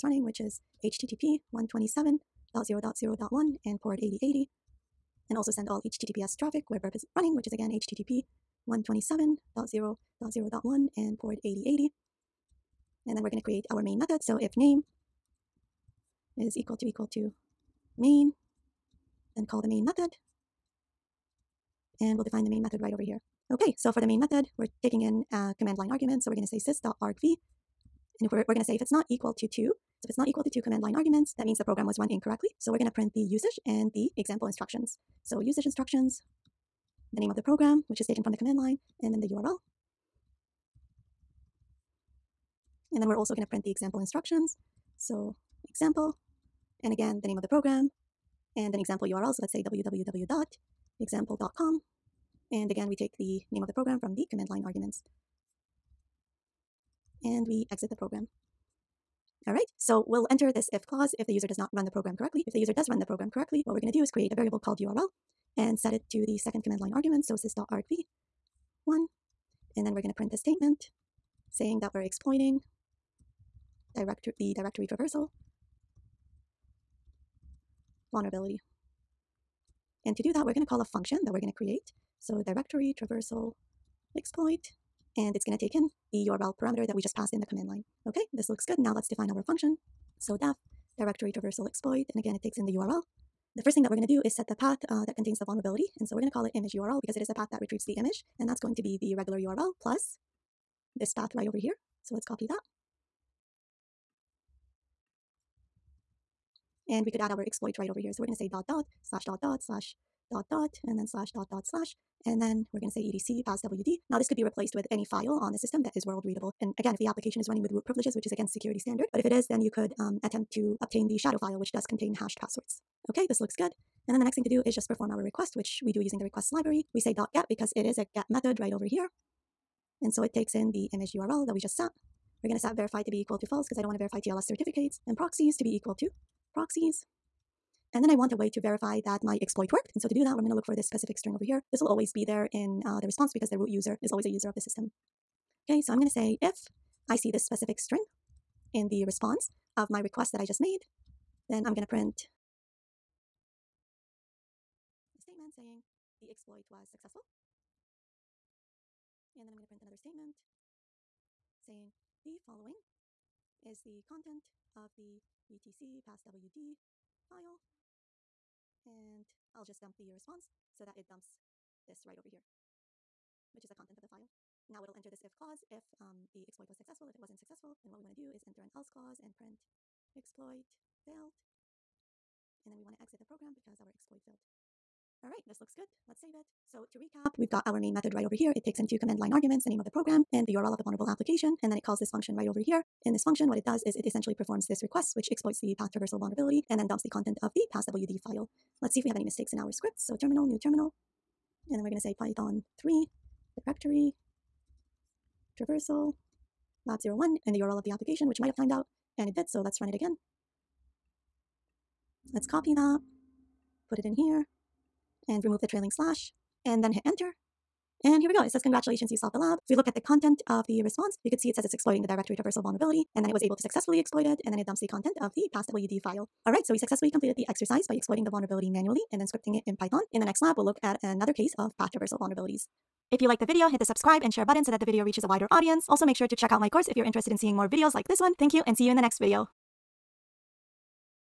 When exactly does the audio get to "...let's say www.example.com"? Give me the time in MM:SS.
00:49.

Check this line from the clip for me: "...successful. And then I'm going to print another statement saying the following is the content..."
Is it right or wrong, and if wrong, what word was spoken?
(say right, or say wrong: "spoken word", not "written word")
right.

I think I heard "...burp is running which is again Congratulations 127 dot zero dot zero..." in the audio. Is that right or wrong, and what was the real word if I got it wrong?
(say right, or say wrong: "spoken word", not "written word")
wrong: "HTTP", not "Congratulations".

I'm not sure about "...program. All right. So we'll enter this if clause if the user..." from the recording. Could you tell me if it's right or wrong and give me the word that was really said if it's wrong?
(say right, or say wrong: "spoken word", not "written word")
right.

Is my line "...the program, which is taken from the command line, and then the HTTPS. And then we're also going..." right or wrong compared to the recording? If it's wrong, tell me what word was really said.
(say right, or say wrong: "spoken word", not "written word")
wrong: "URL", not "HTTPS".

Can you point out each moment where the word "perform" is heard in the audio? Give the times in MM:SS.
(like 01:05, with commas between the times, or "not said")
02:04, 03:14.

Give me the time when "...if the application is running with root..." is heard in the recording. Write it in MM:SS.
01:56.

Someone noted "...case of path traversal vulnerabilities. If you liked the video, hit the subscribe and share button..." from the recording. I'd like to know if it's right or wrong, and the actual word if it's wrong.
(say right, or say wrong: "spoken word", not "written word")
right.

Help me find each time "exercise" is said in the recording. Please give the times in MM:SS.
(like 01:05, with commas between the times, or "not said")
03:47.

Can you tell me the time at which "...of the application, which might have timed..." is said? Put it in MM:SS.
03:27.